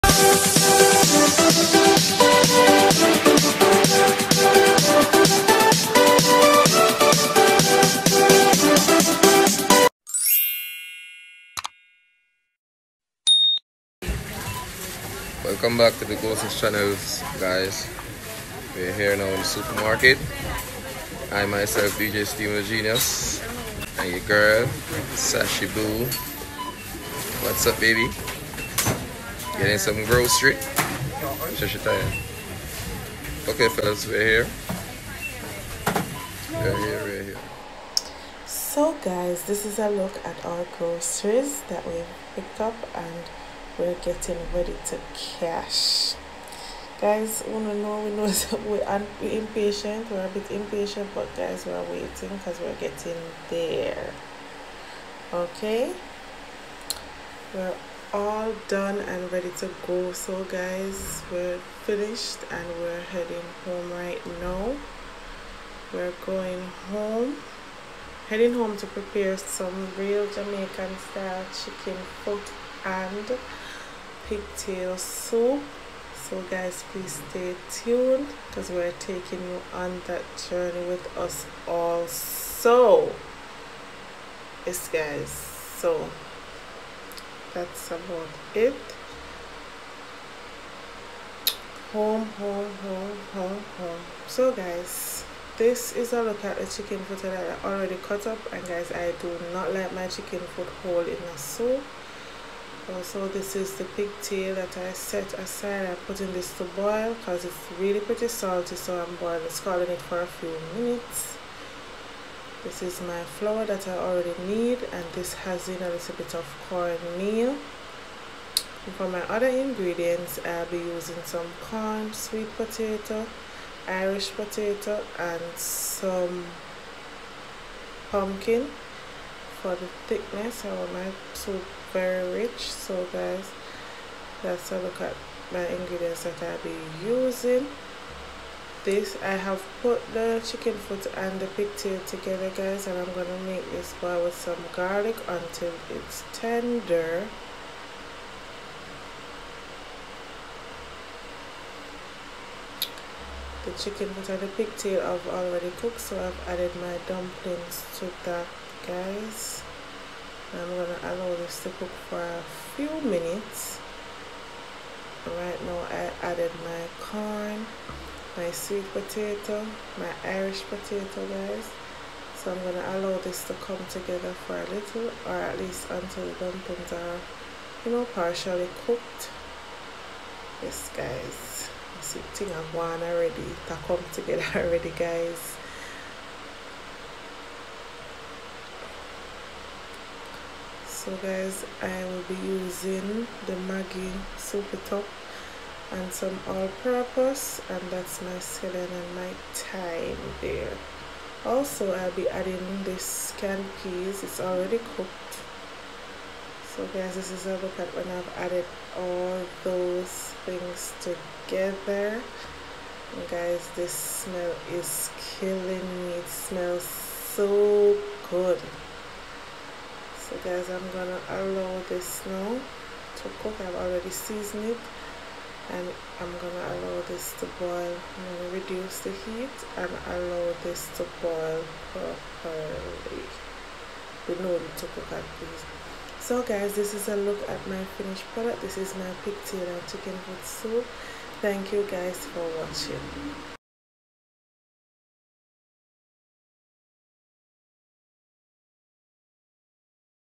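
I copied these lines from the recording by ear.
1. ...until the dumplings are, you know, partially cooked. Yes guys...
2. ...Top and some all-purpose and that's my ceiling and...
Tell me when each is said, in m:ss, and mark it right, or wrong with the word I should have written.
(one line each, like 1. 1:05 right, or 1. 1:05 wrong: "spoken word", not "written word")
1. 2:55 right
2. 3:14 right.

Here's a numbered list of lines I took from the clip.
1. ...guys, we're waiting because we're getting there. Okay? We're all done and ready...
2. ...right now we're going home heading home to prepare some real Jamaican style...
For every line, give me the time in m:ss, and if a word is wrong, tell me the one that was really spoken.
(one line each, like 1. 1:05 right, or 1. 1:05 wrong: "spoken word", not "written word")
1. 0:51 right
2. 1:03 right.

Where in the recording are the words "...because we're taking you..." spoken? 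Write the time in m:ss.
1:18.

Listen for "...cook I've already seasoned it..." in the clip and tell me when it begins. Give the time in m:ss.
3:43.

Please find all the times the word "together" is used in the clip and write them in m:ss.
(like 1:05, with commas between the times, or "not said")
2:22, 2:53, 3:04, 3:31.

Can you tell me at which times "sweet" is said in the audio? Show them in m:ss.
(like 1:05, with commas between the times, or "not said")
2:02, 2:48.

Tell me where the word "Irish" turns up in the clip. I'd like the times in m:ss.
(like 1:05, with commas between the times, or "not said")
2:03, 2:50.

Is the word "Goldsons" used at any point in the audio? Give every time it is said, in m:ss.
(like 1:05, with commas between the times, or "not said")
0:16.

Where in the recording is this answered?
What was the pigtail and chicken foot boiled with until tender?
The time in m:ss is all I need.
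2:24.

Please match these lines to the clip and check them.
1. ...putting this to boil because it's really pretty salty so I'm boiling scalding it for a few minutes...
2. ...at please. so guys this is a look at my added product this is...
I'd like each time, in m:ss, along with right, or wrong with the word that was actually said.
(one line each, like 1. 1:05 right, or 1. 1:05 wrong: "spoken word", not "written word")
1. 1:46 right
2. 3:55 wrong: "finished", not "added".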